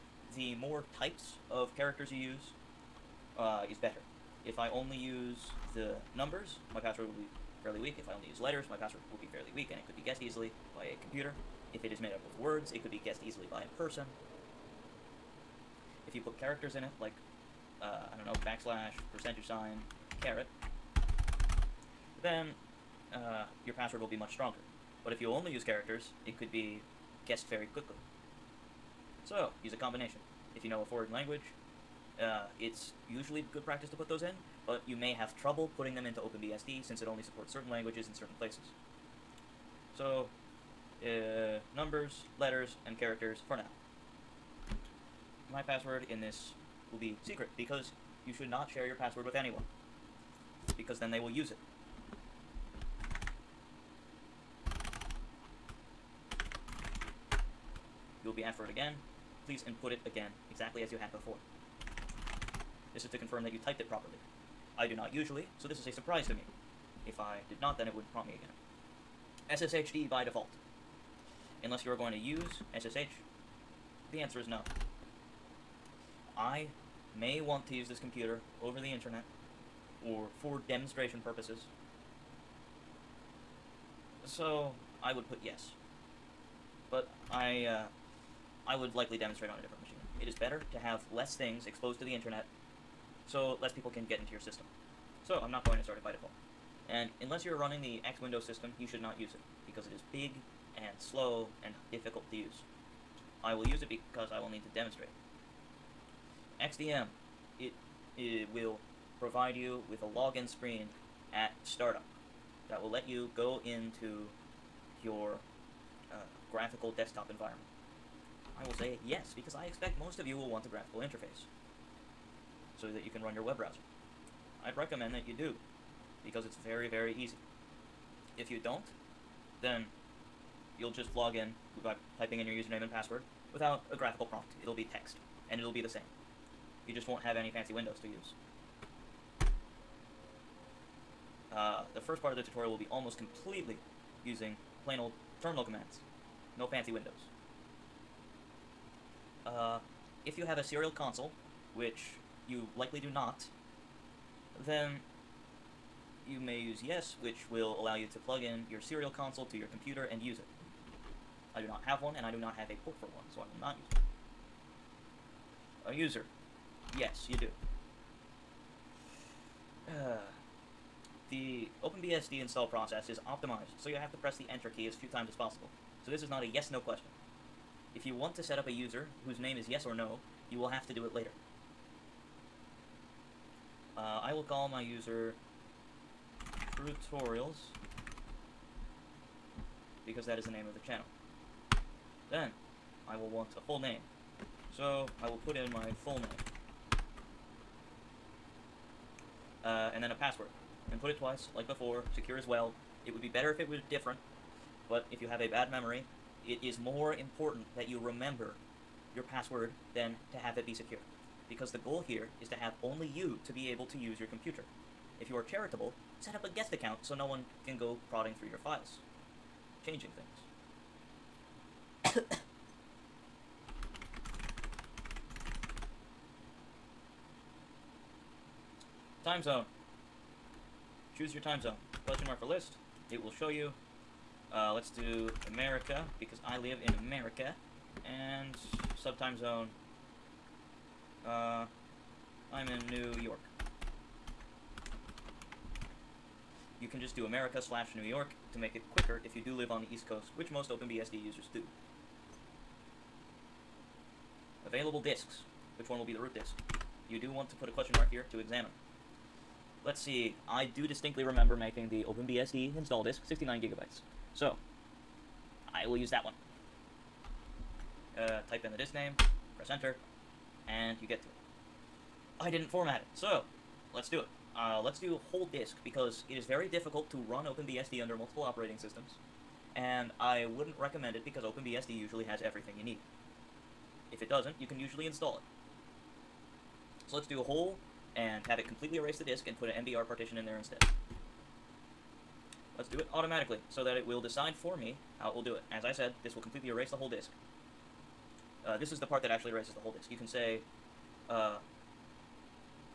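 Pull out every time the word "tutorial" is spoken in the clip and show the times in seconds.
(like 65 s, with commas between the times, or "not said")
142 s.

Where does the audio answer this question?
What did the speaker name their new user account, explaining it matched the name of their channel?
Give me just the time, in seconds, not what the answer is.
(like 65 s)
186 s.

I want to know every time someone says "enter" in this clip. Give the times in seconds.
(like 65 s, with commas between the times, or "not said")
174 s, 269 s.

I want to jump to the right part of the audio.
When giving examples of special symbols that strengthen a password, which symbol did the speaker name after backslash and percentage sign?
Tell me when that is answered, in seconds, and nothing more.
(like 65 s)
20 s.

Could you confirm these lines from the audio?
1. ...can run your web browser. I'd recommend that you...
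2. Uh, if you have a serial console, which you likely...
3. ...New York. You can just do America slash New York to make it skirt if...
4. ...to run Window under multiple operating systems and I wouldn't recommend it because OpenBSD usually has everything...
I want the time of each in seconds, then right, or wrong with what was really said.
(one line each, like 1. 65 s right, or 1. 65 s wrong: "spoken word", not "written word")
1. 123 s right
2. 149 s right
3. 242 s right
4. 277 s wrong: "OpenBSD", not "Window".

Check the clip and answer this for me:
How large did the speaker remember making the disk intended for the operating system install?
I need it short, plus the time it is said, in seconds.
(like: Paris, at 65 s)
69 gigabytes, at 263 s.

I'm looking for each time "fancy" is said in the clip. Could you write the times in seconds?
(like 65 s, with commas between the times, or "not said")
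137 s, 146 s.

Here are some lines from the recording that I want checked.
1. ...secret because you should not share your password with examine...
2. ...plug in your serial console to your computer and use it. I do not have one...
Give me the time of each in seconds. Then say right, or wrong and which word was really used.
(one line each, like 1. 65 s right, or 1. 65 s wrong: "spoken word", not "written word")
1. 47 s wrong: "anyone", not "examine"
2. 158 s right.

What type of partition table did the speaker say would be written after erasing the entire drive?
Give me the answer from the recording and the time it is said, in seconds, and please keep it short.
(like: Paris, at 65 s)
MBR, at 289 s.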